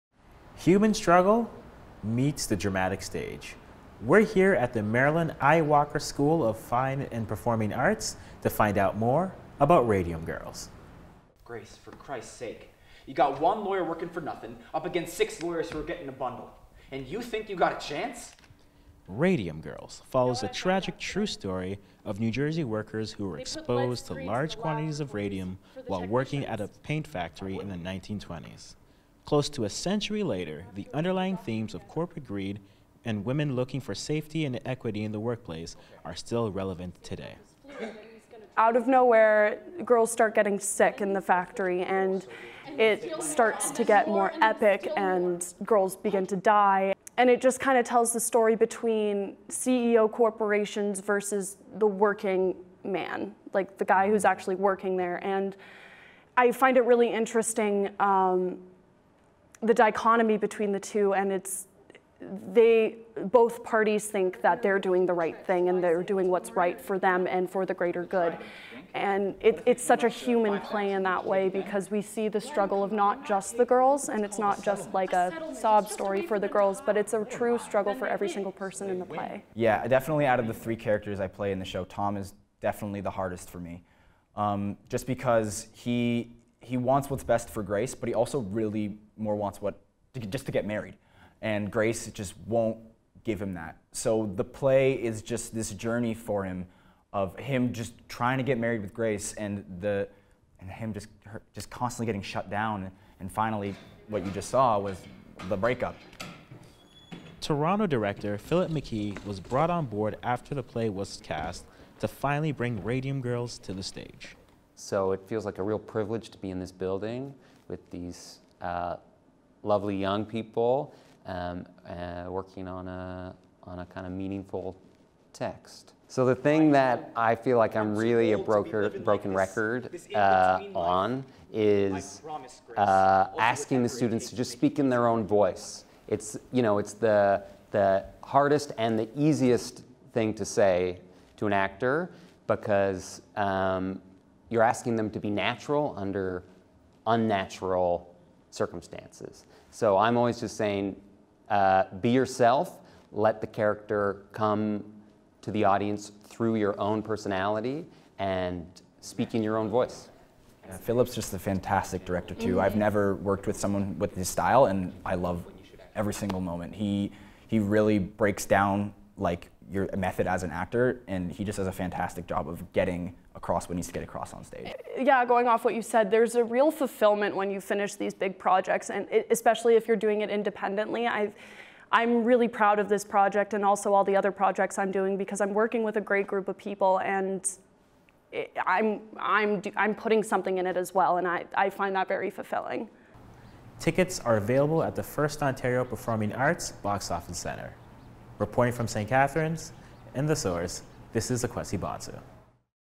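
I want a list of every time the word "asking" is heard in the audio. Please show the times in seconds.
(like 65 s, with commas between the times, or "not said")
133 s, 144 s.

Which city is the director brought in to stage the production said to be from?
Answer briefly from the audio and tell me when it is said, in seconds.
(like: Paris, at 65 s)
Toronto, at 107 s.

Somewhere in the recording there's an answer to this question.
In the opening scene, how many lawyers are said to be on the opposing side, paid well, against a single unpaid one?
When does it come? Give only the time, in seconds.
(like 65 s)
15 s.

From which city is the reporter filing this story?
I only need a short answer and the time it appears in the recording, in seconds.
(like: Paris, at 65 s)
St. Catharines, at 198 s.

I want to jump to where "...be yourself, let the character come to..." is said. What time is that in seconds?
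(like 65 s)
152 s.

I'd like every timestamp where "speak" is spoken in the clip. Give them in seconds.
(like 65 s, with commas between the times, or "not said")
134 s, 158 s.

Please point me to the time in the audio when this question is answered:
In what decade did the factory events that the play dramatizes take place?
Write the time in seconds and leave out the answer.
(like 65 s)
27 s.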